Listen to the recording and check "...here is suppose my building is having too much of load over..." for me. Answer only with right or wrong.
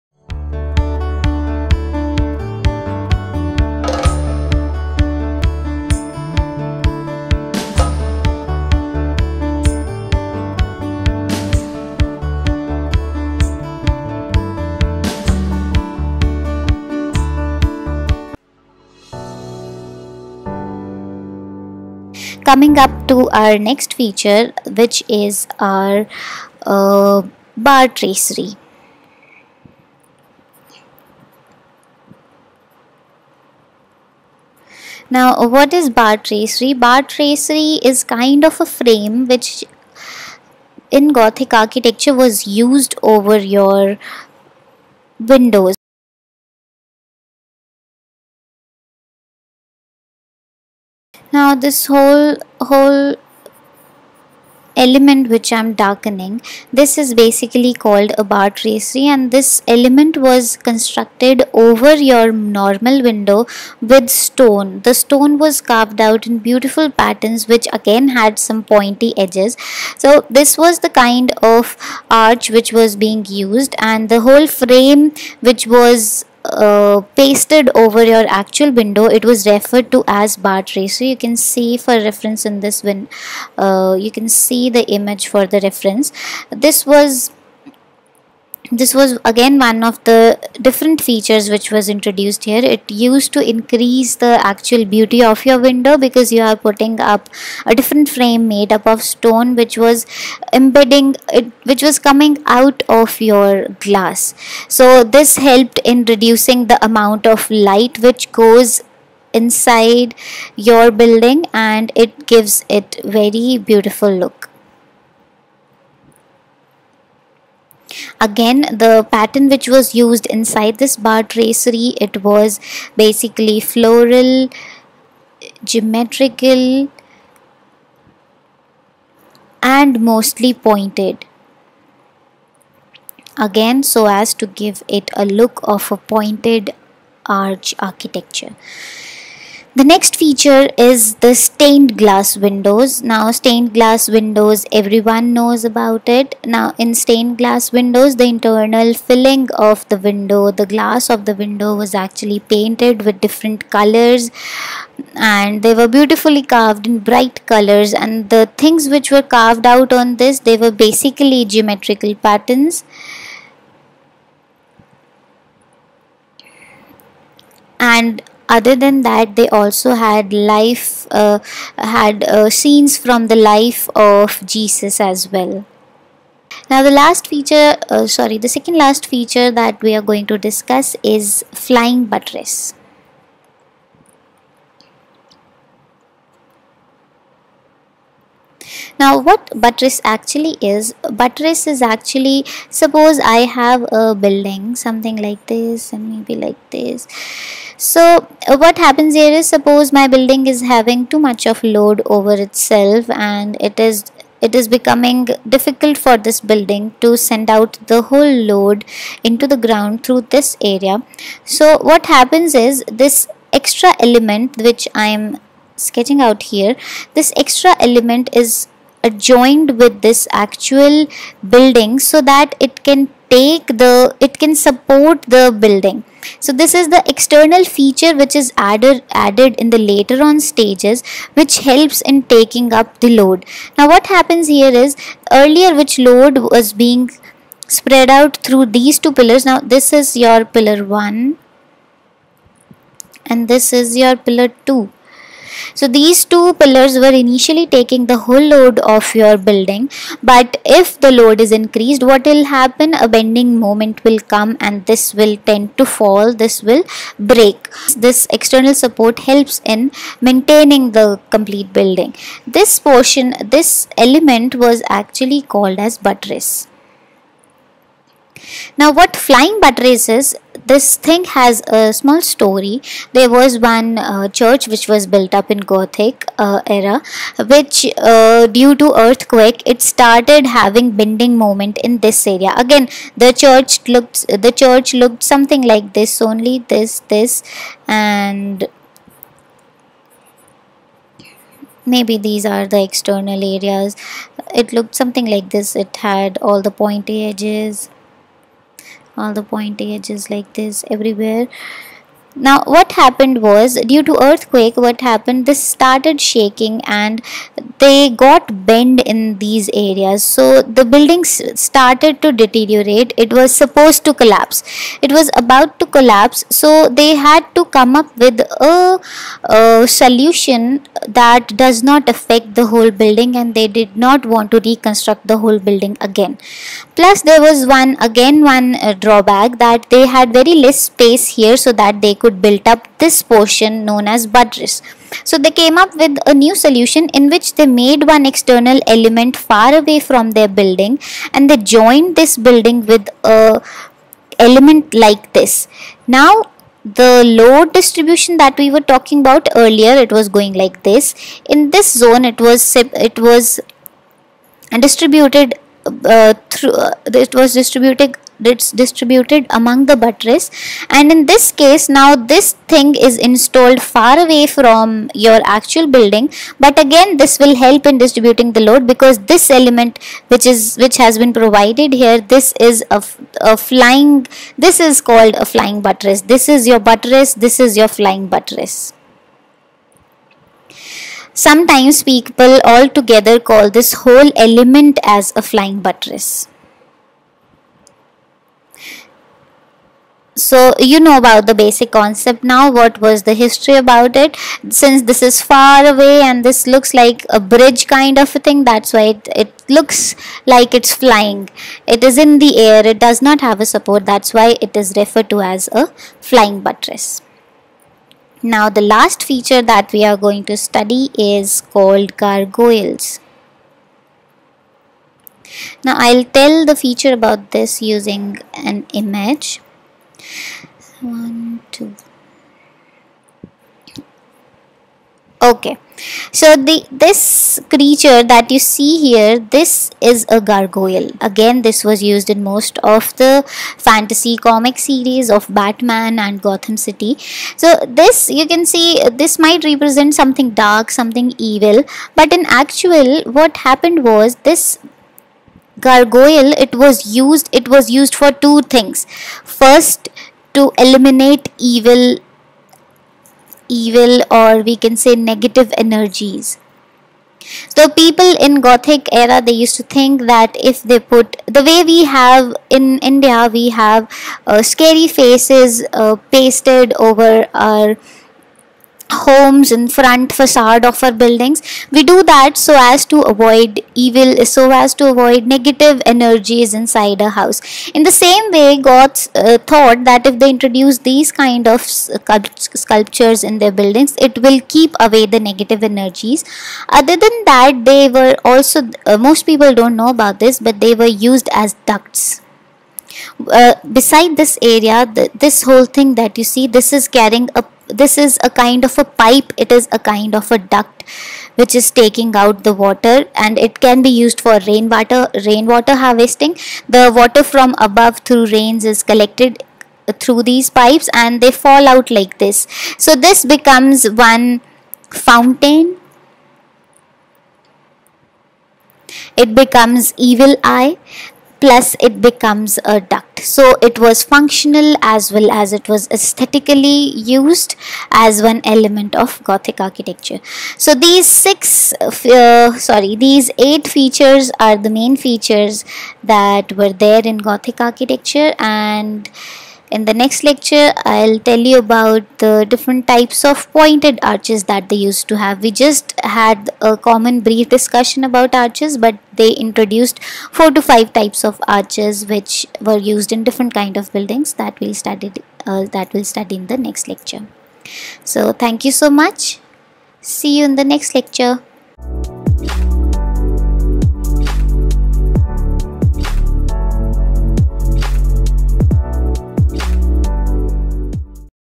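right.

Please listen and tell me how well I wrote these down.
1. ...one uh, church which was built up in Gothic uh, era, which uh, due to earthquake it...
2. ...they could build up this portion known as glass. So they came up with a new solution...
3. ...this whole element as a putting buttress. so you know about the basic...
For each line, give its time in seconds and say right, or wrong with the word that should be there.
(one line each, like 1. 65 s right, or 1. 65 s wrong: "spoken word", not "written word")
1. 273 s right
2. 332 s wrong: "buttress", not "glass"
3. 383 s wrong: "flying", not "putting".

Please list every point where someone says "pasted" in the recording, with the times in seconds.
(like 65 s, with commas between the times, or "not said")
77 s, 466 s.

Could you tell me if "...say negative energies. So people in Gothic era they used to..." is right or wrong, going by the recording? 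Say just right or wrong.
right.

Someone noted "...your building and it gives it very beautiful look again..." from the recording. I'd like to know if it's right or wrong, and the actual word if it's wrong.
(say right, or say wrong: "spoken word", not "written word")
right.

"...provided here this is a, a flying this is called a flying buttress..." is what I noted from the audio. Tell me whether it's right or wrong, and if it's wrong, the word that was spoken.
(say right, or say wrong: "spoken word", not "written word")
right.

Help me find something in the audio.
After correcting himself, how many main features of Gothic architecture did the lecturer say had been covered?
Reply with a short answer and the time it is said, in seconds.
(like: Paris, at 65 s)
8, at 533 s.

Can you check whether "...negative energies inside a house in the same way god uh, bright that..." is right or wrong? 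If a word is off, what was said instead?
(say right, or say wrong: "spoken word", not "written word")
wrong: "thought", not "bright".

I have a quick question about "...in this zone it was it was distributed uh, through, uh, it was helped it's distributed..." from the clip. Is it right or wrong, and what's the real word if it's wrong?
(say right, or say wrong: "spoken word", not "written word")
wrong: "distributed", not "helped".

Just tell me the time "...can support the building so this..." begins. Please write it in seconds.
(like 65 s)
224 s.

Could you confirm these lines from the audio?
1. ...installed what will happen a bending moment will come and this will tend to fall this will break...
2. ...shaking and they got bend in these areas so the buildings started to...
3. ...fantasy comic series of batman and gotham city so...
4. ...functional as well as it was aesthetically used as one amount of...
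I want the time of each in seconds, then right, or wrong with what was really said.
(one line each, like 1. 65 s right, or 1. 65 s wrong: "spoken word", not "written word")
1. 251 s wrong: "increased", not "installed"
2. 306 s right
3. 433 s right
4. 524 s wrong: "element", not "amount".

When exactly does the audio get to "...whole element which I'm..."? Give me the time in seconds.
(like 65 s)
52 s.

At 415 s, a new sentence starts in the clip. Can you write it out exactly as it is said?
Now I'll tell the feature about this using an image.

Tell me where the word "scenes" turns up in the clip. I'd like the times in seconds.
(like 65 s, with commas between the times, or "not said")
172 s.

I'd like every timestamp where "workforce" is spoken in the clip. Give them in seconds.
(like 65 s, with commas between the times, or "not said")
not said.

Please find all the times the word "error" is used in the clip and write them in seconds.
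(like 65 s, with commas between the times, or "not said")
not said.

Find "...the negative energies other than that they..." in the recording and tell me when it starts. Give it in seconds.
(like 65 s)
485 s.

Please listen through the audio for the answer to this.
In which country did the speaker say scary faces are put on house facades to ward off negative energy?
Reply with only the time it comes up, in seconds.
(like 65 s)
462 s.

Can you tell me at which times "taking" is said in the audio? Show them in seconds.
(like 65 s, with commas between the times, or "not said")
232 s, 247 s, 501 s.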